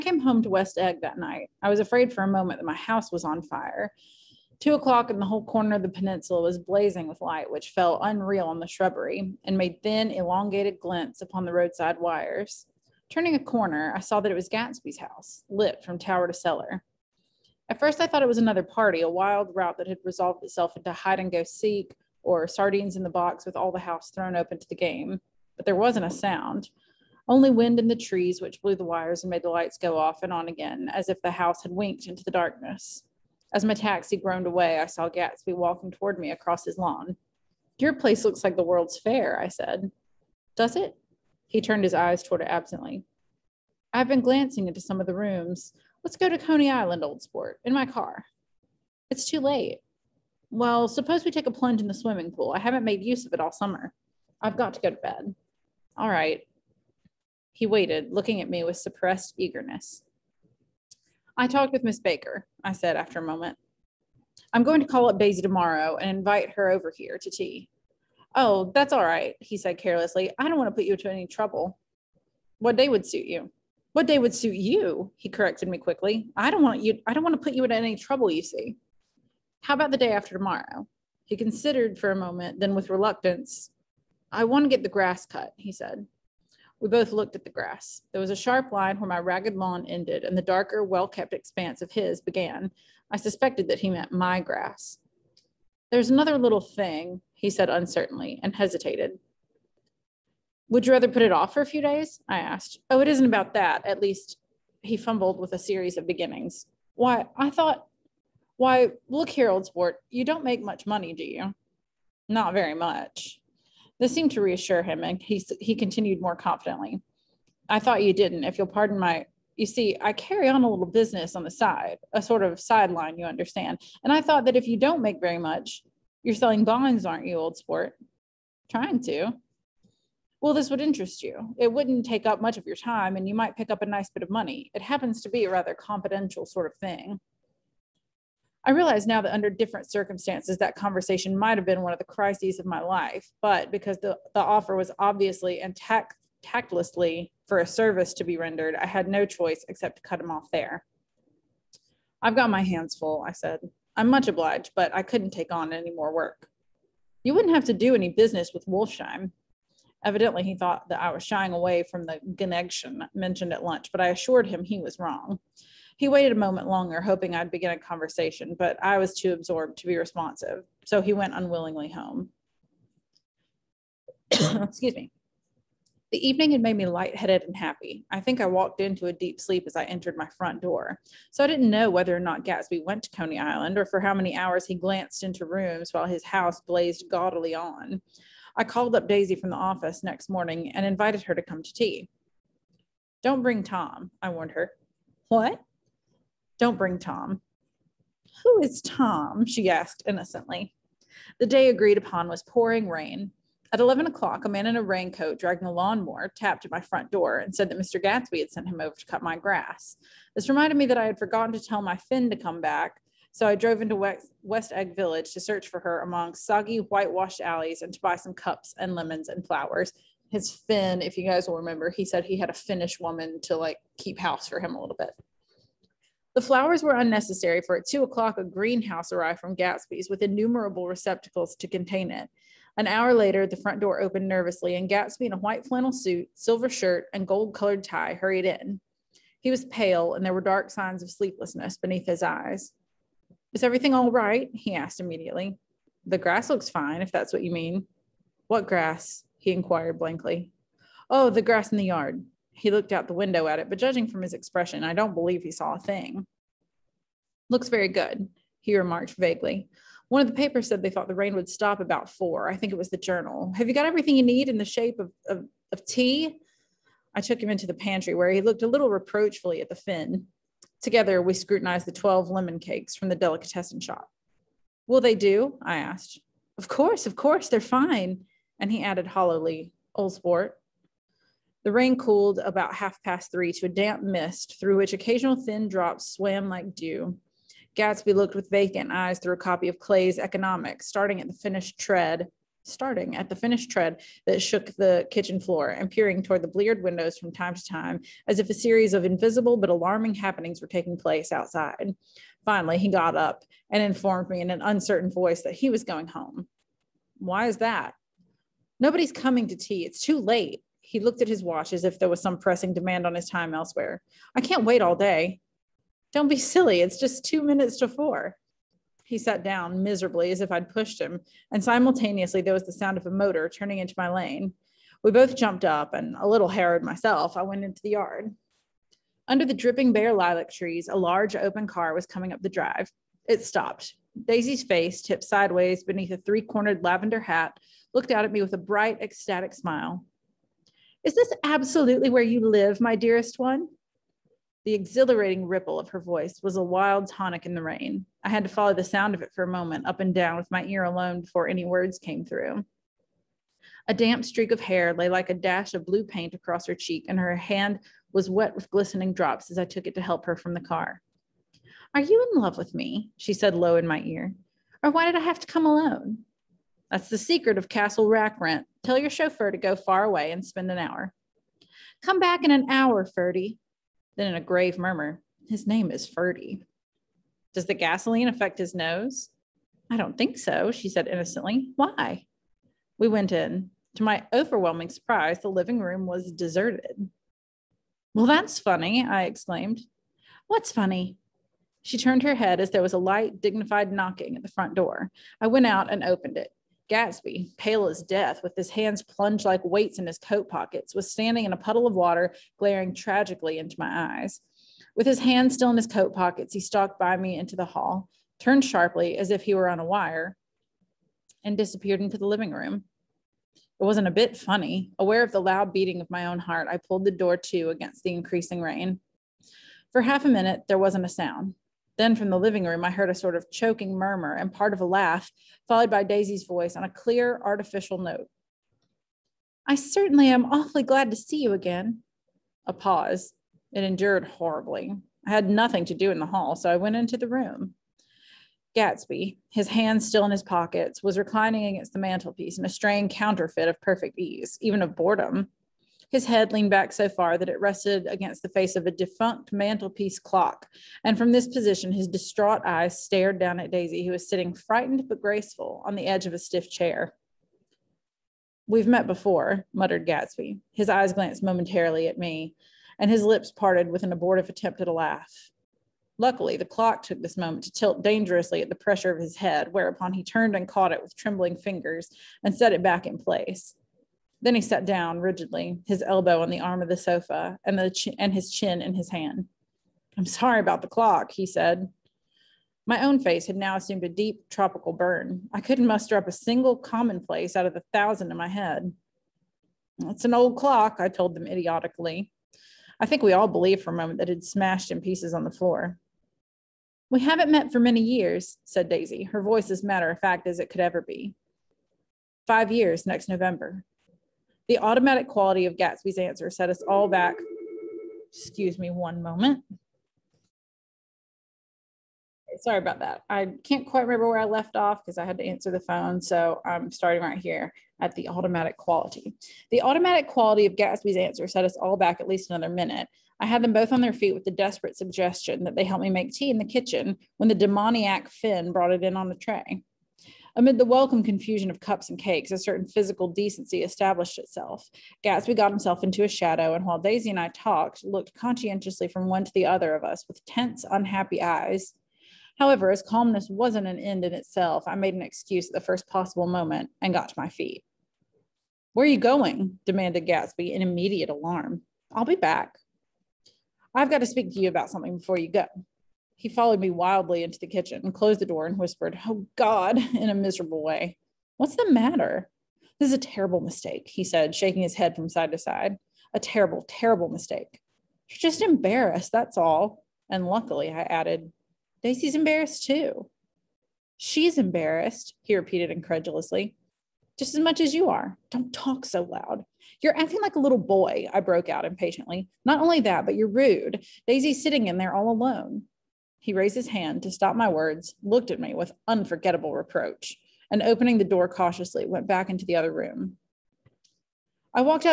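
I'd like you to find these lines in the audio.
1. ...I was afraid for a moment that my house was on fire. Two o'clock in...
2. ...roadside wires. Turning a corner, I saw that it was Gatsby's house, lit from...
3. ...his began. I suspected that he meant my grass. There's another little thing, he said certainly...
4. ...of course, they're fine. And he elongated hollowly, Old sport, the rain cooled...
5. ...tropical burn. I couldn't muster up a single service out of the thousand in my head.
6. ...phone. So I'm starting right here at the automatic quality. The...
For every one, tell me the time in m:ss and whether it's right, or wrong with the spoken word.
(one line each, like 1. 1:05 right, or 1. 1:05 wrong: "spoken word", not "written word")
1. 0:01 right
2. 0:11 right
3. 1:31 wrong: "uncertainly", not "certainly"
4. 4:37 wrong: "added", not "elongated"
5. 8:04 wrong: "commonplace", not "service"
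6. 8:35 right.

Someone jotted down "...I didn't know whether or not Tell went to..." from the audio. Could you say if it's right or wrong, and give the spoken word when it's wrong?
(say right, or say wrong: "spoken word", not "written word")
wrong: "Gatsby", not "Tell".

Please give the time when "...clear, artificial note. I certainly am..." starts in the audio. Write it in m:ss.
7:06.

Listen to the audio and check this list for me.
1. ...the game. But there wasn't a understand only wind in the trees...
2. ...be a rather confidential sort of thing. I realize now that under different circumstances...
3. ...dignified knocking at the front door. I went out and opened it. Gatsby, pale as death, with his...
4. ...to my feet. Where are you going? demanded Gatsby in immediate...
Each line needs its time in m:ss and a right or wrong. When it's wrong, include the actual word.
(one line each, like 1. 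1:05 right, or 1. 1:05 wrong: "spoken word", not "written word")
1. 0:24 wrong: "sound", not "understand"
2. 2:15 right
3. 6:33 right
4. 9:07 right.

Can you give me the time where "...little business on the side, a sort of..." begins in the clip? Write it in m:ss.
2:00.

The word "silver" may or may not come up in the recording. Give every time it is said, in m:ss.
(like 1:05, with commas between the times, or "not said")
3:56.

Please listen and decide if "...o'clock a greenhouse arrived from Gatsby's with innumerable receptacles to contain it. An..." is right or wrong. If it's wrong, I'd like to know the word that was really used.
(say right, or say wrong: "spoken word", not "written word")
right.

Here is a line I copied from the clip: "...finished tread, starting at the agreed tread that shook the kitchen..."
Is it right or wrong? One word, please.
wrong.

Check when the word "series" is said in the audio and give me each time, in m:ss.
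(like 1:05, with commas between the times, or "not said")
1:45, 4:58.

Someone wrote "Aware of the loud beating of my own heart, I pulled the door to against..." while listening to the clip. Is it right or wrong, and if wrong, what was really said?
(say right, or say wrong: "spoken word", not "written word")
right.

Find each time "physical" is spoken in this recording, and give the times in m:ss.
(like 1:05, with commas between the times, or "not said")
8:52.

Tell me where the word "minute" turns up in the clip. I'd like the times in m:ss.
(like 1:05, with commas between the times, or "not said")
5:17, 7:00, 8:42.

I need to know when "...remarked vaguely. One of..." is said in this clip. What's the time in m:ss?
4:18.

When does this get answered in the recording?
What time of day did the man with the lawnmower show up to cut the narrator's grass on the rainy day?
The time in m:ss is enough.
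3:23.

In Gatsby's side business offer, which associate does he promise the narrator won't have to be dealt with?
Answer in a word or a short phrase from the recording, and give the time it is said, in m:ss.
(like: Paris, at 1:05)
Wolfsheim, at 2:38.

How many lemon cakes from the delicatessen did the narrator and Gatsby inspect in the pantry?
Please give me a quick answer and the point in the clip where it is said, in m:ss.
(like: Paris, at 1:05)
12, at 4:31.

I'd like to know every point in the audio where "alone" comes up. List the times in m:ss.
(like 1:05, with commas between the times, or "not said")
5:50, 6:05, 9:45.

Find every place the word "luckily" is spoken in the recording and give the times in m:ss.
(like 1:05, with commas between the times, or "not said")
7:46, 9:30.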